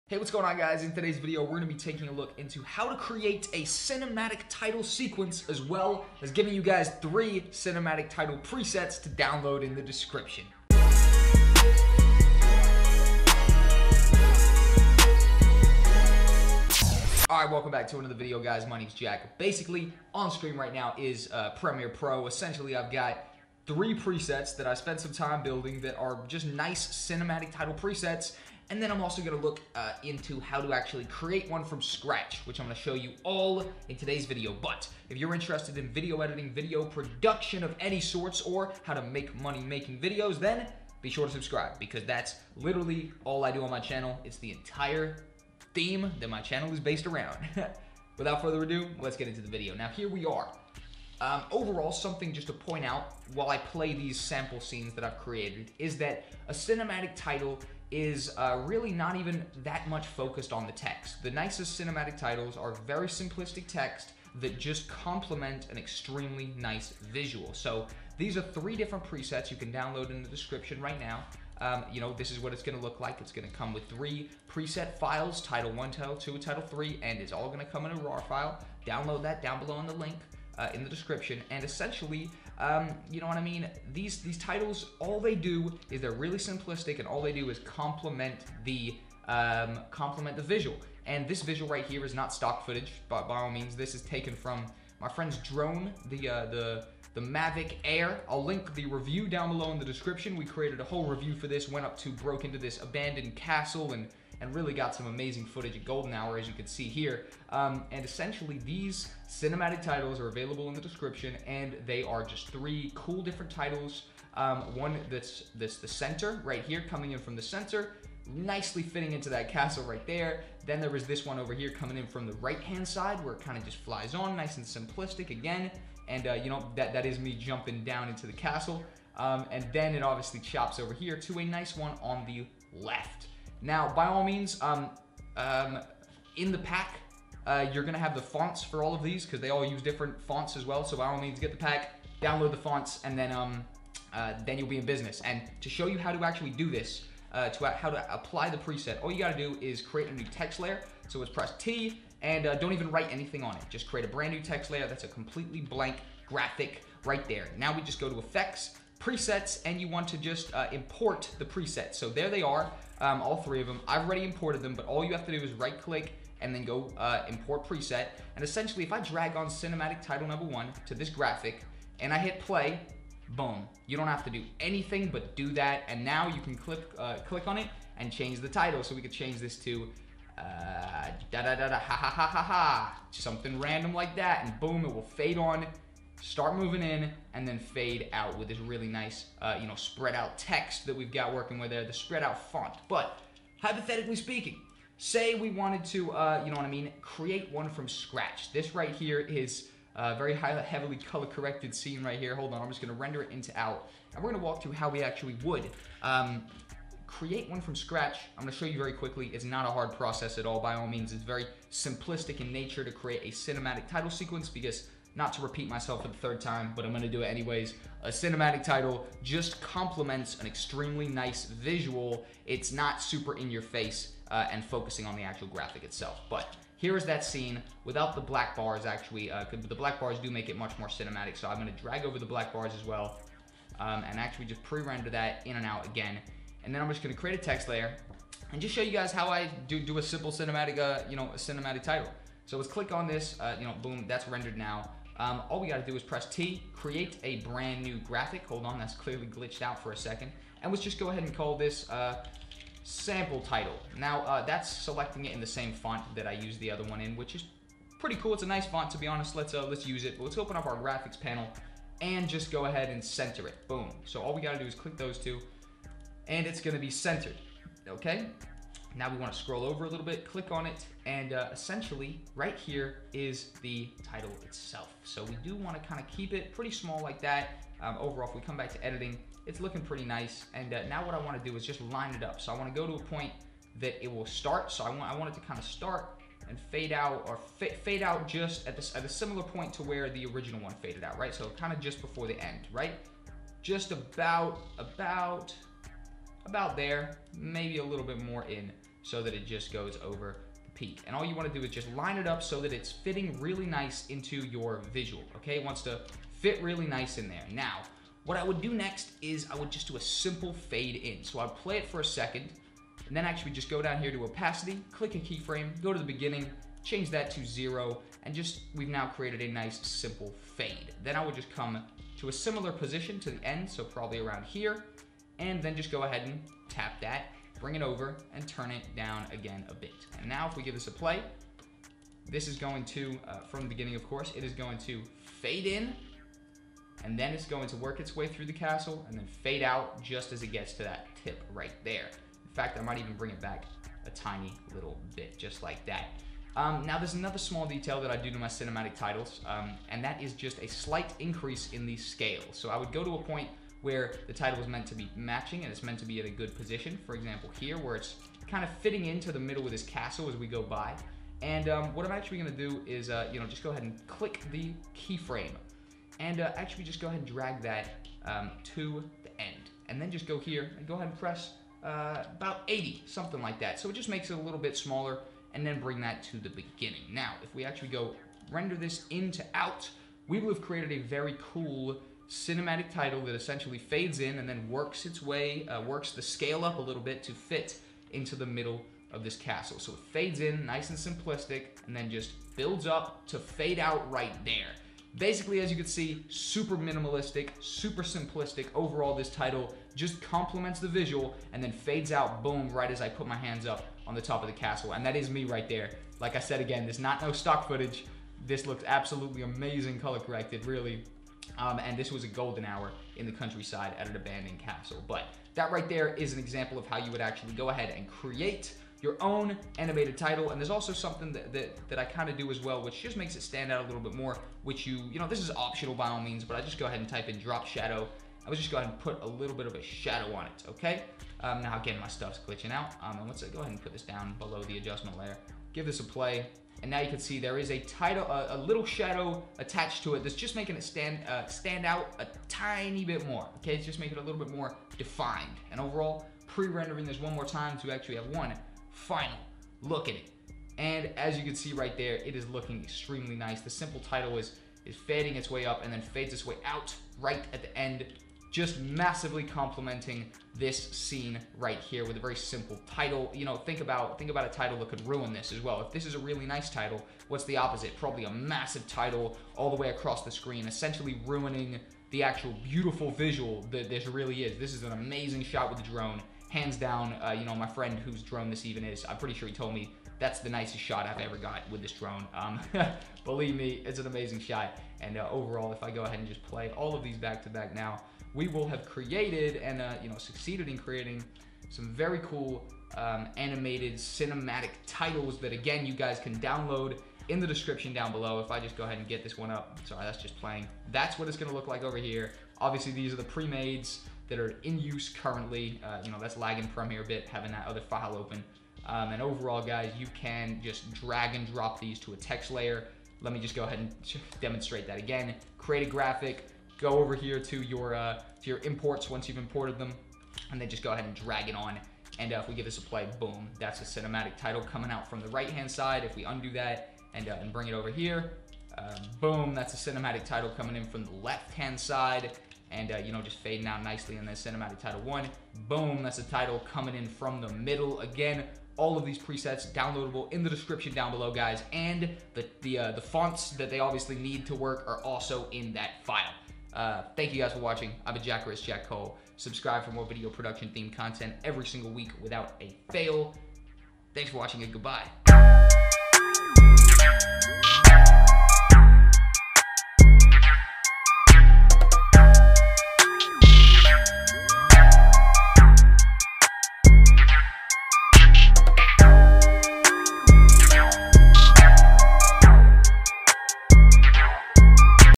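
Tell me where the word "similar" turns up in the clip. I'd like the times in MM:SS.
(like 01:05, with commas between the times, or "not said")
04:49, 05:22.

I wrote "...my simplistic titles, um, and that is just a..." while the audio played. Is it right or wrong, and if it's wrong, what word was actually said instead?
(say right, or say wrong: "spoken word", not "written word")
wrong: "cinematic", not "simplistic".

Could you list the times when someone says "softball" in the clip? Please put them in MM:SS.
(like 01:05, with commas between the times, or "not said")
not said.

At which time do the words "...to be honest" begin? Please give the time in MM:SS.
04:18.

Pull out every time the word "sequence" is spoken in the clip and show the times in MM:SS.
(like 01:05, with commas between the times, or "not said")
00:04, 03:34.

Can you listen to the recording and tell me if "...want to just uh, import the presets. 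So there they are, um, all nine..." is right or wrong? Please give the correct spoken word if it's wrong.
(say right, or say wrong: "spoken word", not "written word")
wrong: "three", not "nine".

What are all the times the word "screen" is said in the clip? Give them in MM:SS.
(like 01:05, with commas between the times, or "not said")
00:20, 07:50.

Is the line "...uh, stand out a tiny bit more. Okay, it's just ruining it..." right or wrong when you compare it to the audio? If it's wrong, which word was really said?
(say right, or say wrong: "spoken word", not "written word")
wrong: "making", not "ruining".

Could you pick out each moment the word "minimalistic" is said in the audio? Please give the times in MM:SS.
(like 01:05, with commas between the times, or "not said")
06:36.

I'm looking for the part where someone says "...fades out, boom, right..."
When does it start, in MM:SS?
06:41.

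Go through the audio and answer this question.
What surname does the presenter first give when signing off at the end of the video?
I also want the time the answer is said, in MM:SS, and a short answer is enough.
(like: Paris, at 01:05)
Riss, at 09:08.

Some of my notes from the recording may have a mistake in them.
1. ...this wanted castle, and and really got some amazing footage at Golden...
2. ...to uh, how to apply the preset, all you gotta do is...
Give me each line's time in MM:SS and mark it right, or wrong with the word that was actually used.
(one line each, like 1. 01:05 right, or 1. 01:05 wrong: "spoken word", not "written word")
1. 01:42 wrong: "abandoned", not "wanted"
2. 02:27 right.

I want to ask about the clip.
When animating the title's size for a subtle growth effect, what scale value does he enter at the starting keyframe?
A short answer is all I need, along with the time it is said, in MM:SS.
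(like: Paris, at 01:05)
80, at 06:12.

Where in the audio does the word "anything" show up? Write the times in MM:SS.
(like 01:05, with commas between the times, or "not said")
02:33, 02:54.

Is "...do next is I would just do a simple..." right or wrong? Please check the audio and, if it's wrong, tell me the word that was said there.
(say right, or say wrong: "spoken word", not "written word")
right.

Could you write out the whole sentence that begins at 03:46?
But here is that scene without the black bars actually.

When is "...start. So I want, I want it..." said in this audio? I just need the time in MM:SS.
04:44.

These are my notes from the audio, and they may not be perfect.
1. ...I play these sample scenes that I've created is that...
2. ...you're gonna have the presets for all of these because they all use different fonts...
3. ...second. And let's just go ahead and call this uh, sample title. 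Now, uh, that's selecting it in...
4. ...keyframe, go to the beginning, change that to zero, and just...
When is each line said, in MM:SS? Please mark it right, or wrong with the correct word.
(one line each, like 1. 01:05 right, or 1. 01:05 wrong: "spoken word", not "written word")
1. 00:53 right
2. 02:17 wrong: "fonts", not "presets"
3. 04:09 right
4. 05:15 right.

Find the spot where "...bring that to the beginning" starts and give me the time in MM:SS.
06:15.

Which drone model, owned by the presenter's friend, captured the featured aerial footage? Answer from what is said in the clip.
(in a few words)
Mavic Air.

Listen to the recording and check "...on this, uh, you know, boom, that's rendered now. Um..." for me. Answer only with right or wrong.
right.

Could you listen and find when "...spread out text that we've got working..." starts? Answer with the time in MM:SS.
03:09.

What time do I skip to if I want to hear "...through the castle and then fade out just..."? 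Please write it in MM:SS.
05:38.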